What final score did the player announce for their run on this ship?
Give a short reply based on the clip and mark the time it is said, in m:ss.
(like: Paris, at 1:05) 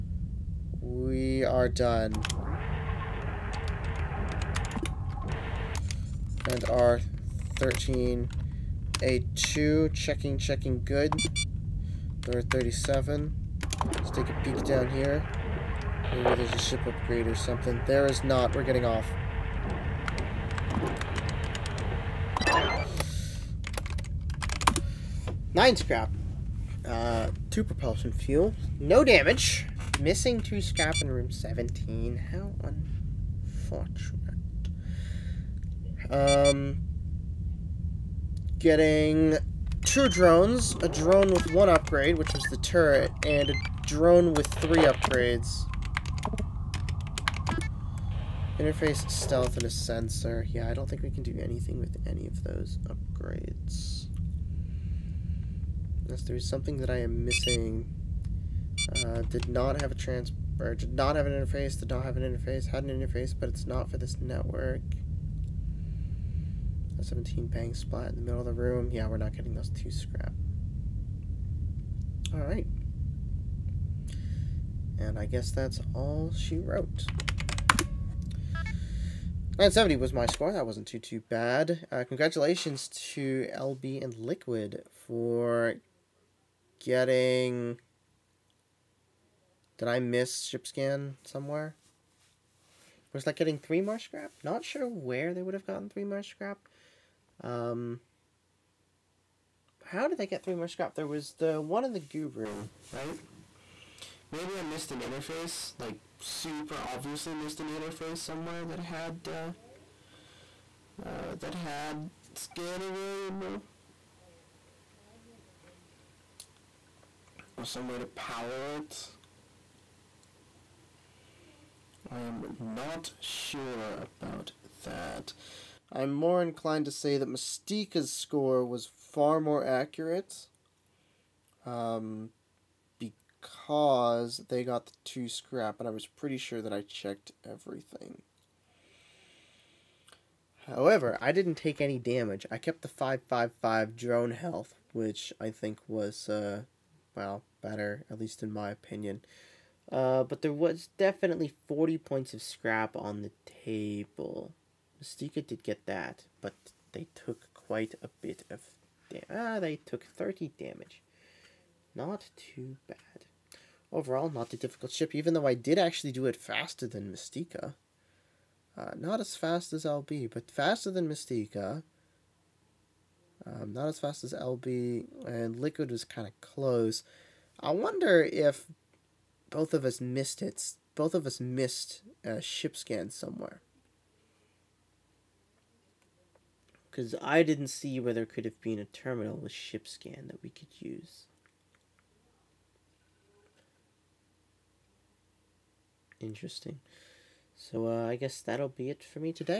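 970, at 1:19.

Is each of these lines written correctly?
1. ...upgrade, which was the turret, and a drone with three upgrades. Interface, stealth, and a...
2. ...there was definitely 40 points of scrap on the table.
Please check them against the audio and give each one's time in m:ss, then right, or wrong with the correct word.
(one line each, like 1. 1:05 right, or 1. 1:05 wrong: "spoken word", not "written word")
1. 0:41 right
2. 2:30 right.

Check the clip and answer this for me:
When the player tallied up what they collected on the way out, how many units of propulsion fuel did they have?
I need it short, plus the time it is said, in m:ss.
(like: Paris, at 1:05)
2, at 0:27.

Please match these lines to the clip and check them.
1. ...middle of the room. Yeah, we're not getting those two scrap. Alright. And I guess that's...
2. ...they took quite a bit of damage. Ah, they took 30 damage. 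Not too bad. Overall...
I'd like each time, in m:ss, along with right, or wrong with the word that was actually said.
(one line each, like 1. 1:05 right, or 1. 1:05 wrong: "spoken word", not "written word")
1. 1:08 right
2. 2:36 right.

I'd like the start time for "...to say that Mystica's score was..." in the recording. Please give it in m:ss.
2:06.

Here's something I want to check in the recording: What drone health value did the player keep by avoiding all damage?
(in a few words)
555.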